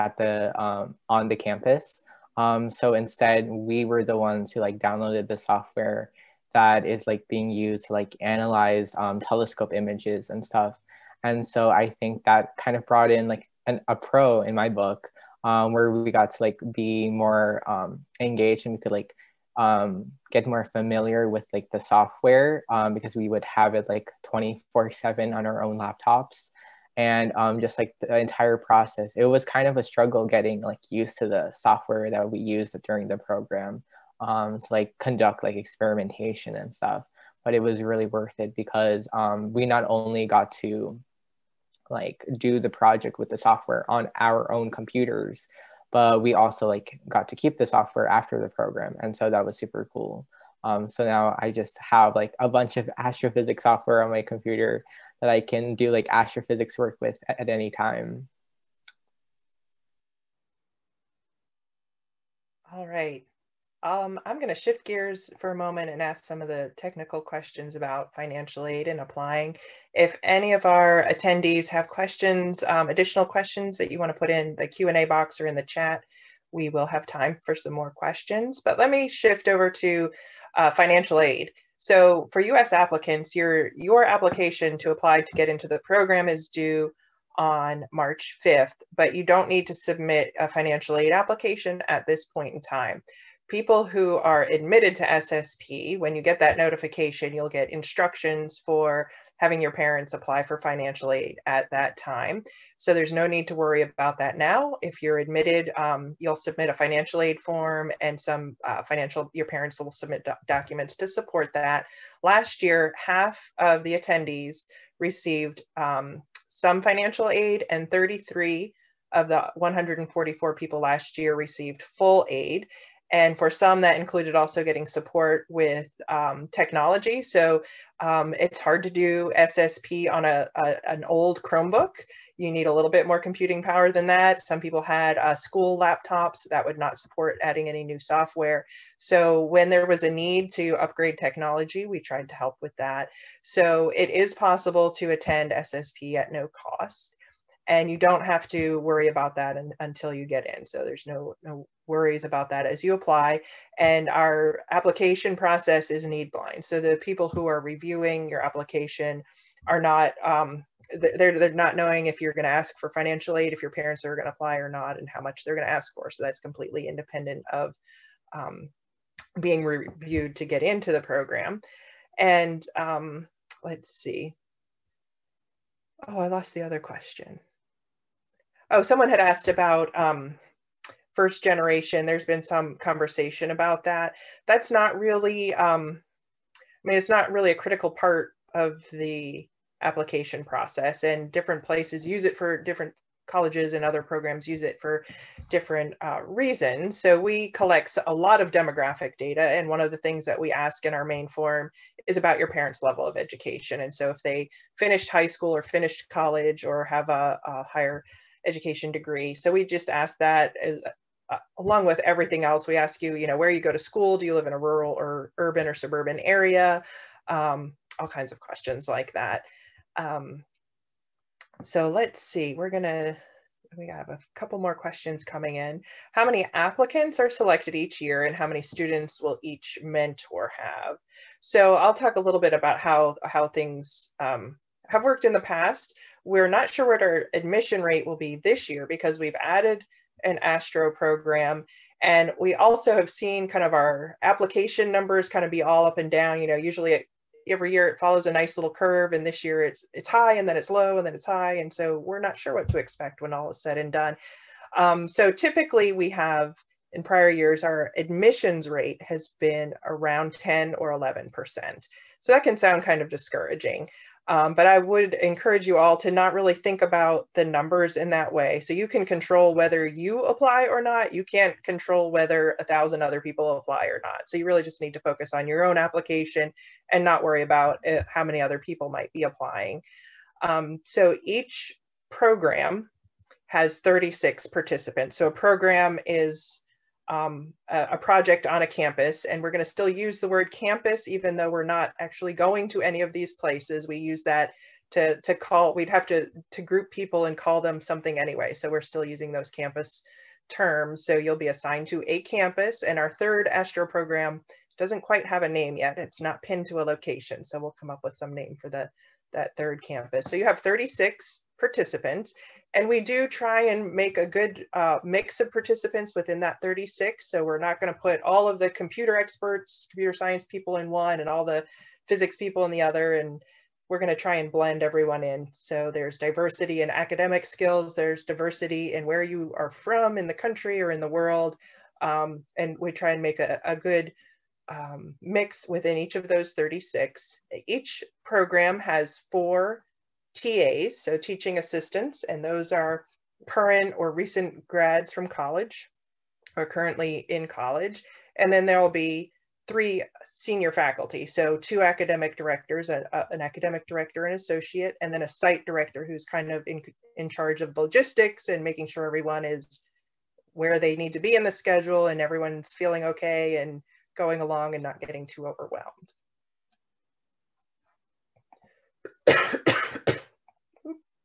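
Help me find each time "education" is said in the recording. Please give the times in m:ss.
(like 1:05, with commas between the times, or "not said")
3:23, 3:28.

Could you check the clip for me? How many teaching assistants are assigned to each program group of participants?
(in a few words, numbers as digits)
4.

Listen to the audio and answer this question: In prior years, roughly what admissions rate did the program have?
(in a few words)
10 or 11%.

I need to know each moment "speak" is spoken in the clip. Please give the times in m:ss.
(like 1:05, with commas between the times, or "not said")
not said.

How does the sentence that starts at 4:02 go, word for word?
And we also have seen kind of our application numbers kind of be all up and down.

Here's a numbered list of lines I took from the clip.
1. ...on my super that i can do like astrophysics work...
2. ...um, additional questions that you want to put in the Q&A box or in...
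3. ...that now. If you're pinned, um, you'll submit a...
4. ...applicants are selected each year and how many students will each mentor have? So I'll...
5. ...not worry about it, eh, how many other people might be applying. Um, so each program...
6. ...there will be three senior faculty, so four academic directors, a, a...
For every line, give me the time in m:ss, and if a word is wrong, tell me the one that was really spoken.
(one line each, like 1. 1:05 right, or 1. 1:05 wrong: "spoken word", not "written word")
1. 0:54 wrong: "computer", not "super"
2. 1:12 right
3. 1:44 wrong: "admitted", not "pinned"
4. 3:46 right
5. 4:37 right
6. 5:48 wrong: "two", not "four".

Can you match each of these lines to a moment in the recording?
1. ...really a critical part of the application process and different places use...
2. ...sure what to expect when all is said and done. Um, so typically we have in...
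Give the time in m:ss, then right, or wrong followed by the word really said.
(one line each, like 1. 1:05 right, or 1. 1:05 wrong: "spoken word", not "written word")
1. 3:07 right
2. 4:12 right.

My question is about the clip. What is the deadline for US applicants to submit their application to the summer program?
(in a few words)
March 5th.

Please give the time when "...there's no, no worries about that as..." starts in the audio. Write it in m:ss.
2:30.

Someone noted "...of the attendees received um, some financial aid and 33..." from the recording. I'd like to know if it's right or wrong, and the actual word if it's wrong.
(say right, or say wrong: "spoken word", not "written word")
right.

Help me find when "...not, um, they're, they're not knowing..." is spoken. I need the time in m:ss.
2:39.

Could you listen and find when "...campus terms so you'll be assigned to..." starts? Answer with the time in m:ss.
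4:59.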